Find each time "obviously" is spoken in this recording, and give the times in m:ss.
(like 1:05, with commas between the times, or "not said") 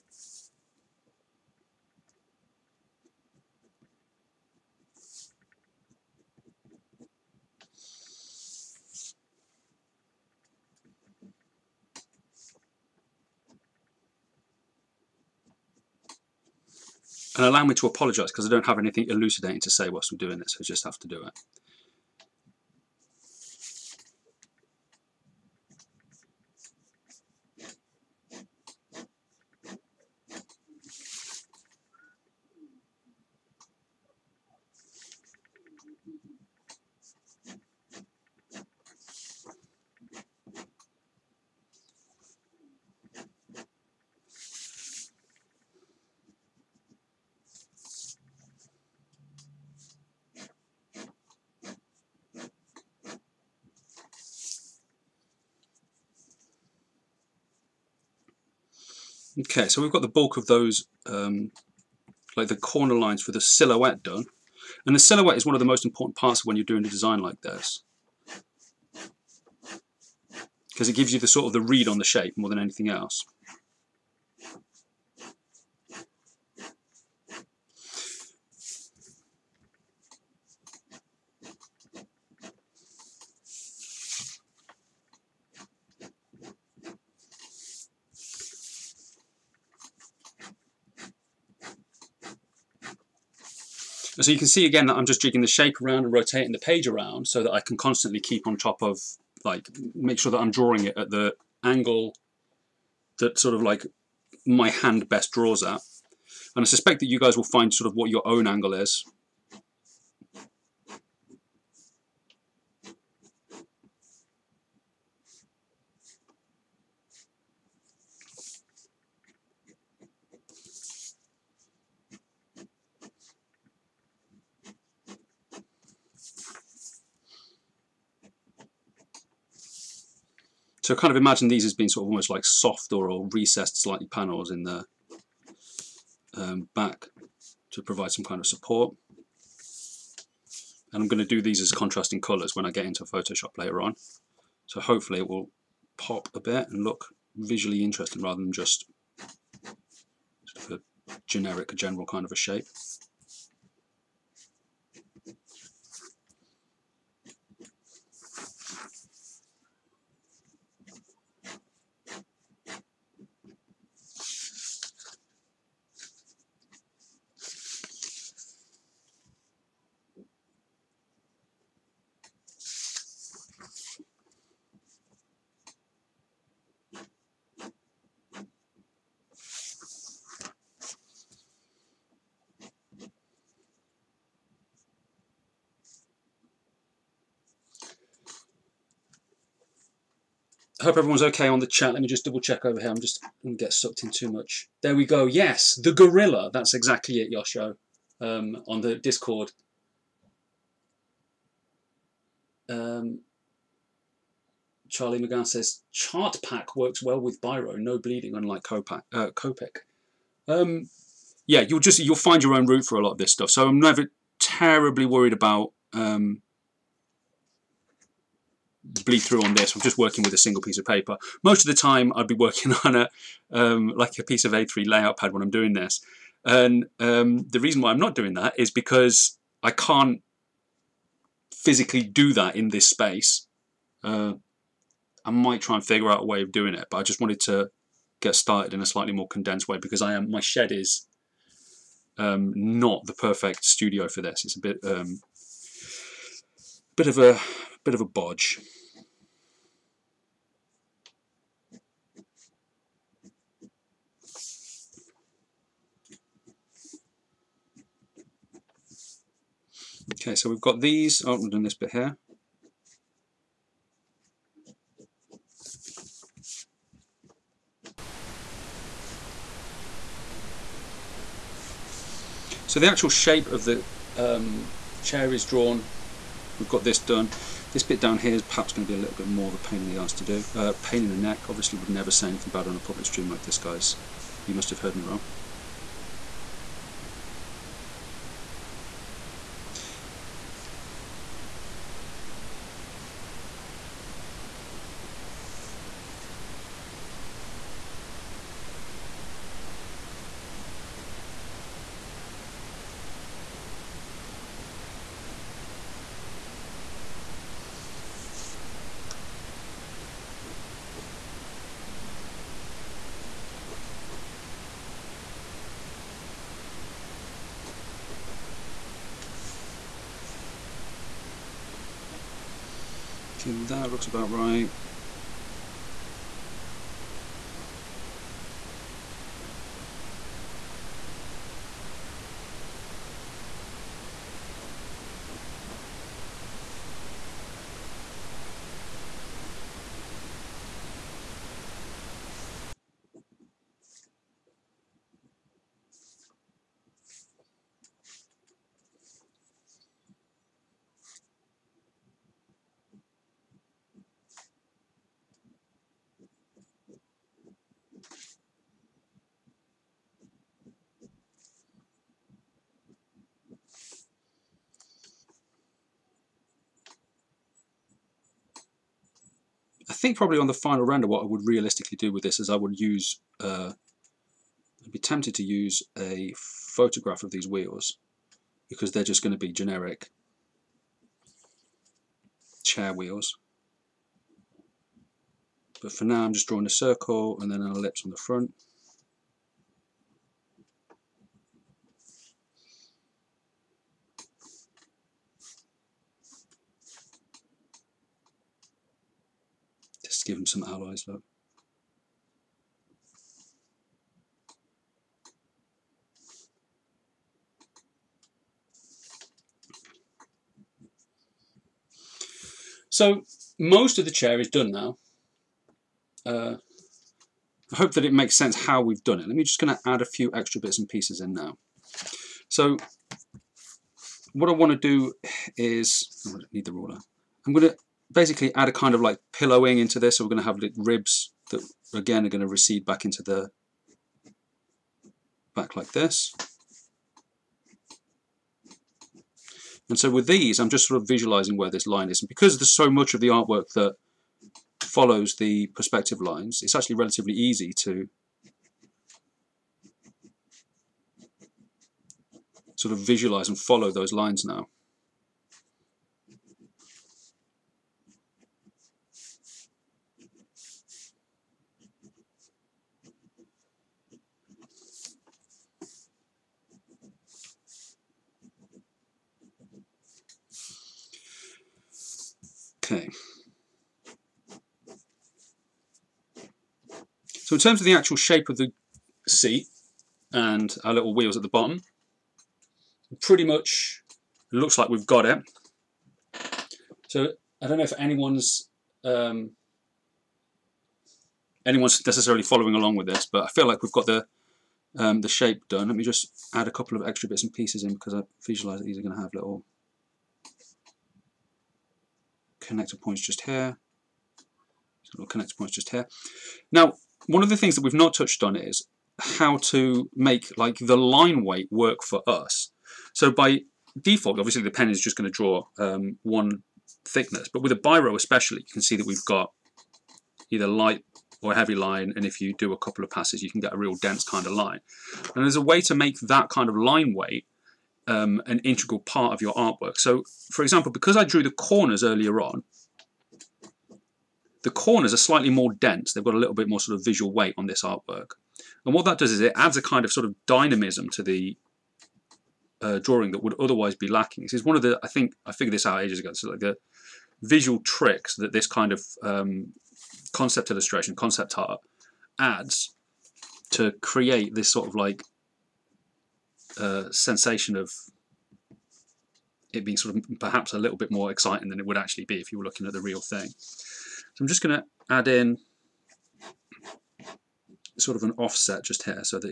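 4:41, 8:34.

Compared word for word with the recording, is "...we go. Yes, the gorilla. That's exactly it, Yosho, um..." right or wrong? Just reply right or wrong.
right.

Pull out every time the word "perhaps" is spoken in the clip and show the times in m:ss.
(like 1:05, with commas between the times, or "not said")
4:38, 9:20.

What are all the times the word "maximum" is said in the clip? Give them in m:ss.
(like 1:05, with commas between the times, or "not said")
not said.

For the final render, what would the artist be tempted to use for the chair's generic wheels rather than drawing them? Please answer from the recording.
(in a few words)
A photograph.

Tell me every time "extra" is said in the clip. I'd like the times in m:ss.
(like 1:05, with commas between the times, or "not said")
7:00, 8:17.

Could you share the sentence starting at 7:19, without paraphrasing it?
And so with these, I'm just sort of visualizing where this line is.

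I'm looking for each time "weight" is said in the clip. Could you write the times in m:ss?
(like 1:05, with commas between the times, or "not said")
8:31, 8:47, 8:57.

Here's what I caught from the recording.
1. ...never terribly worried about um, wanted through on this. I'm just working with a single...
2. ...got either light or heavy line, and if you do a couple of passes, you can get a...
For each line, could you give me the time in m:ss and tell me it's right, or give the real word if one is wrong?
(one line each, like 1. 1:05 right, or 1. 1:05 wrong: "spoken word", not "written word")
1. 3:33 wrong: "bleed", not "wanted"
2. 8:39 right.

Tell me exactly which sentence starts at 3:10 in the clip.
hope everyone's okay on the chat.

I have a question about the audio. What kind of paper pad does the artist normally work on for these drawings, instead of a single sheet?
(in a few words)
A3 layout pad.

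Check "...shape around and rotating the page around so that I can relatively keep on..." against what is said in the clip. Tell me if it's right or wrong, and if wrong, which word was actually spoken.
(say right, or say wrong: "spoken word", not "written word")
wrong: "constantly", not "relatively".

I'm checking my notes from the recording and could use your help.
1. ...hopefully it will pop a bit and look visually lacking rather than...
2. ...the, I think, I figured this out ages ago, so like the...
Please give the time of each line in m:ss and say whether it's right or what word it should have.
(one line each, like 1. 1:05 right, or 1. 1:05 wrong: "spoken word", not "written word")
1. 2:24 wrong: "interesting", not "lacking"
2. 9:04 right.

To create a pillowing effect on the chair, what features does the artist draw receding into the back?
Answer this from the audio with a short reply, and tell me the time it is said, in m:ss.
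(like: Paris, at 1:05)
Ribs, at 7:10.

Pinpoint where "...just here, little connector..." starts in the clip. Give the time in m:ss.
8:23.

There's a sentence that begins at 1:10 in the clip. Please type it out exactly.
Because it gives you the sort of the read on the shape more than anything else.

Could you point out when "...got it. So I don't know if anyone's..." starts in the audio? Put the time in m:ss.
8:05.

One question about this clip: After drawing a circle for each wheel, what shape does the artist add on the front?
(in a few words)
An ellipse.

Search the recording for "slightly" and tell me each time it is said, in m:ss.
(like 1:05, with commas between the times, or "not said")
2:13, 3:58, 8:55.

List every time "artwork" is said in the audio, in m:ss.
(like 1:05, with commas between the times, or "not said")
7:23, 8:49, 8:57.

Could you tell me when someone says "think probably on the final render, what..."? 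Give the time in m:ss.
6:10.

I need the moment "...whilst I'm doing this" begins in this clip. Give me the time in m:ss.
0:19.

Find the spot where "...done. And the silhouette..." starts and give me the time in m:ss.
1:04.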